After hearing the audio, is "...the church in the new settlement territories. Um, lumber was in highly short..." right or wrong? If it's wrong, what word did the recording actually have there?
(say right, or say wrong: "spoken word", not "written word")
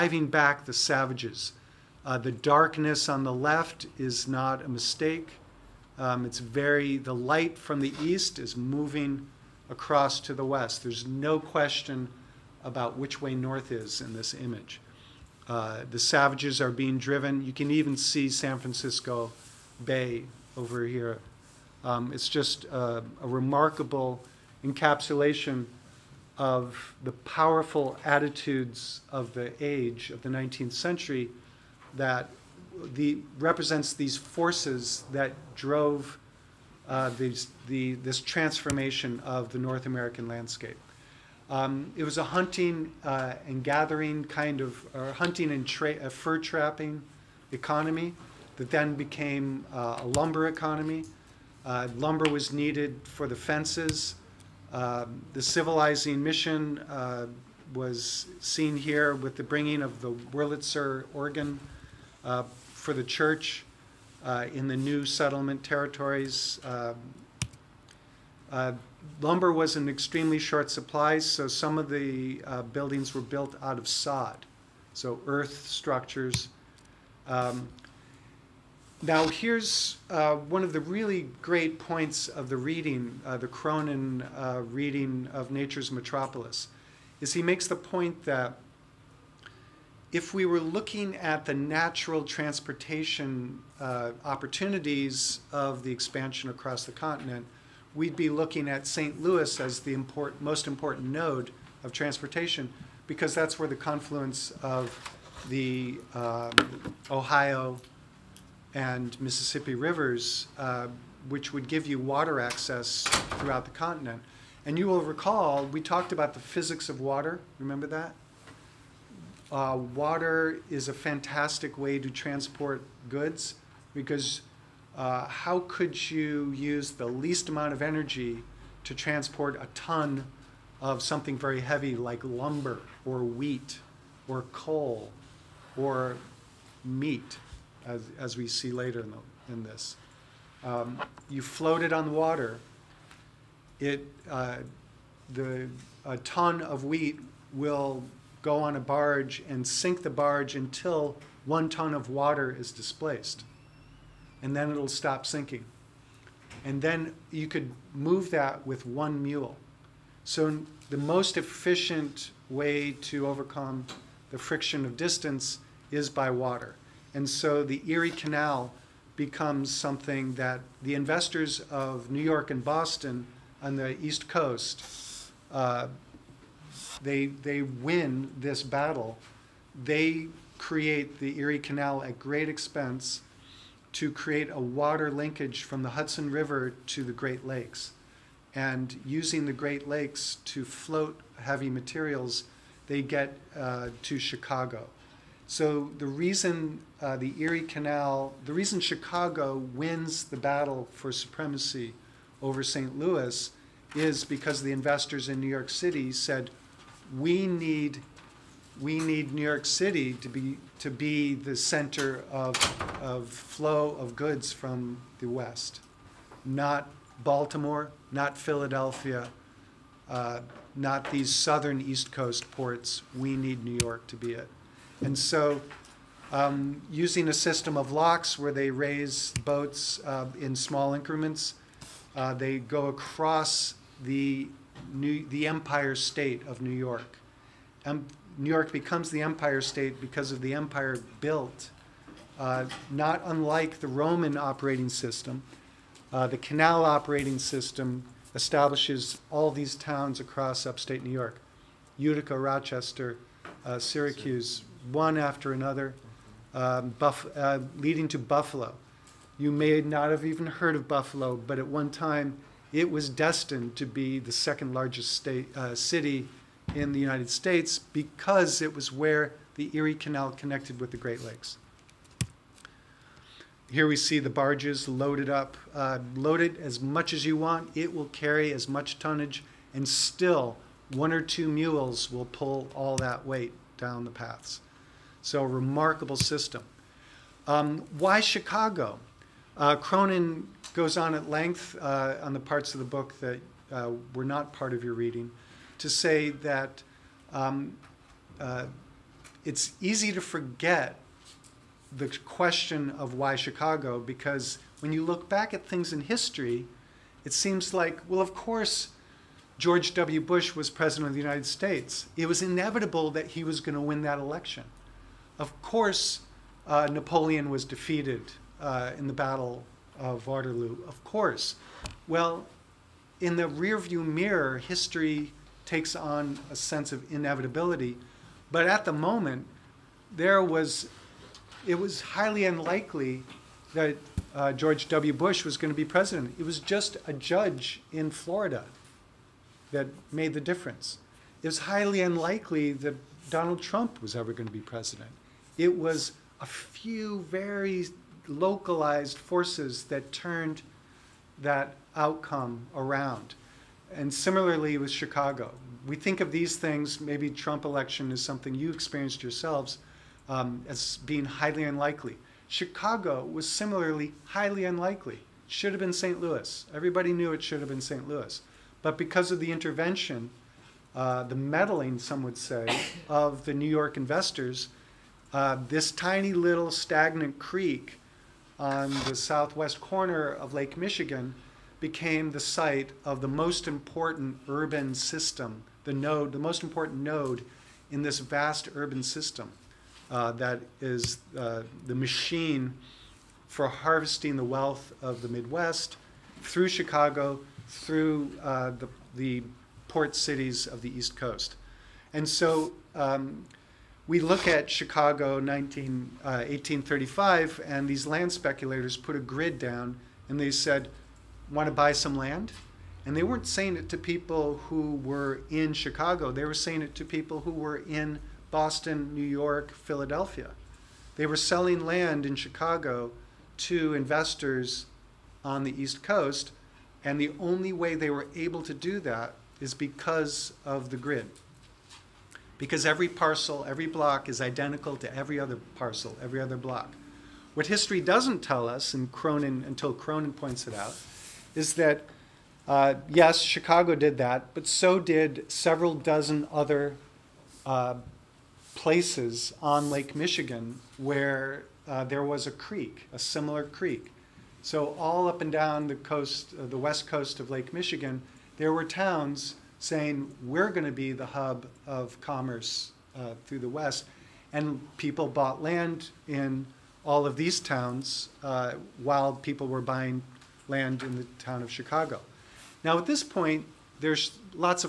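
wrong: "extremely", not "highly".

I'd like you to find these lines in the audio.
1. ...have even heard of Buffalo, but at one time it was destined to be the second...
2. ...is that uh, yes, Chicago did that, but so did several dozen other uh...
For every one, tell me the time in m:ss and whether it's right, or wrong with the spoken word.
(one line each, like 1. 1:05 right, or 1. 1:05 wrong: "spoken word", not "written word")
1. 4:20 right
2. 7:21 right.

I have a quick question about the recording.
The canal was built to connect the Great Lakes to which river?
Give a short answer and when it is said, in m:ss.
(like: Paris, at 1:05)
Hudson River, at 3:05.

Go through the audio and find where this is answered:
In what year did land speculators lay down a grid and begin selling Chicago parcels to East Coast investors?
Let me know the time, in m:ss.
6:46.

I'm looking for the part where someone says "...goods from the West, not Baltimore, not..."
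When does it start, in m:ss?
3:34.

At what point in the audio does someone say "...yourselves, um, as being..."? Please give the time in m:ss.
5:59.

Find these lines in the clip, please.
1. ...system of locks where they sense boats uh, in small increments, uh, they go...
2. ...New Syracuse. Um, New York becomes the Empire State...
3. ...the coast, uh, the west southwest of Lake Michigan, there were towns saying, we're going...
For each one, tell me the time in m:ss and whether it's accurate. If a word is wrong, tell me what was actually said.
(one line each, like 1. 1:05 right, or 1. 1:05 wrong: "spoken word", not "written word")
1. 3:47 wrong: "raise", not "sense"
2. 3:56 wrong: "York", not "Syracuse"
3. 7:35 wrong: "coast", not "southwest".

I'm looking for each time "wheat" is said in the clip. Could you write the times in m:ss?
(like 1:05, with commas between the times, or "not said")
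2:13, 2:26.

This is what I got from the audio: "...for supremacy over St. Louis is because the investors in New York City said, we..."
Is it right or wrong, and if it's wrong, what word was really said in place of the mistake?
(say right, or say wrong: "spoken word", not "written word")
right.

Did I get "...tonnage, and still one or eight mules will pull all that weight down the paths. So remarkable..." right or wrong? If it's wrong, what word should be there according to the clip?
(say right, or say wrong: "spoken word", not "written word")
wrong: "two", not "eight".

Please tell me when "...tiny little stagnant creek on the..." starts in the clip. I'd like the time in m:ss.
6:15.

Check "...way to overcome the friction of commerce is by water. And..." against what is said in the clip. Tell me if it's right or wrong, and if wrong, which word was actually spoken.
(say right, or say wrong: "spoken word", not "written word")
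wrong: "distance", not "commerce".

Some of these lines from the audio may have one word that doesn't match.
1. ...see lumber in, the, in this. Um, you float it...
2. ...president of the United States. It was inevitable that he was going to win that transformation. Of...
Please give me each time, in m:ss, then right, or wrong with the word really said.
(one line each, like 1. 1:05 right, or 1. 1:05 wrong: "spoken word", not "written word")
1. 2:18 wrong: "later", not "lumber"
2. 5:10 wrong: "election", not "transformation".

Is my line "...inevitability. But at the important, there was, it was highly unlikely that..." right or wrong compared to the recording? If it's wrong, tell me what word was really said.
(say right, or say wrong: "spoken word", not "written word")
wrong: "moment", not "important".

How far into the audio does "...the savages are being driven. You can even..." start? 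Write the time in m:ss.
0:15.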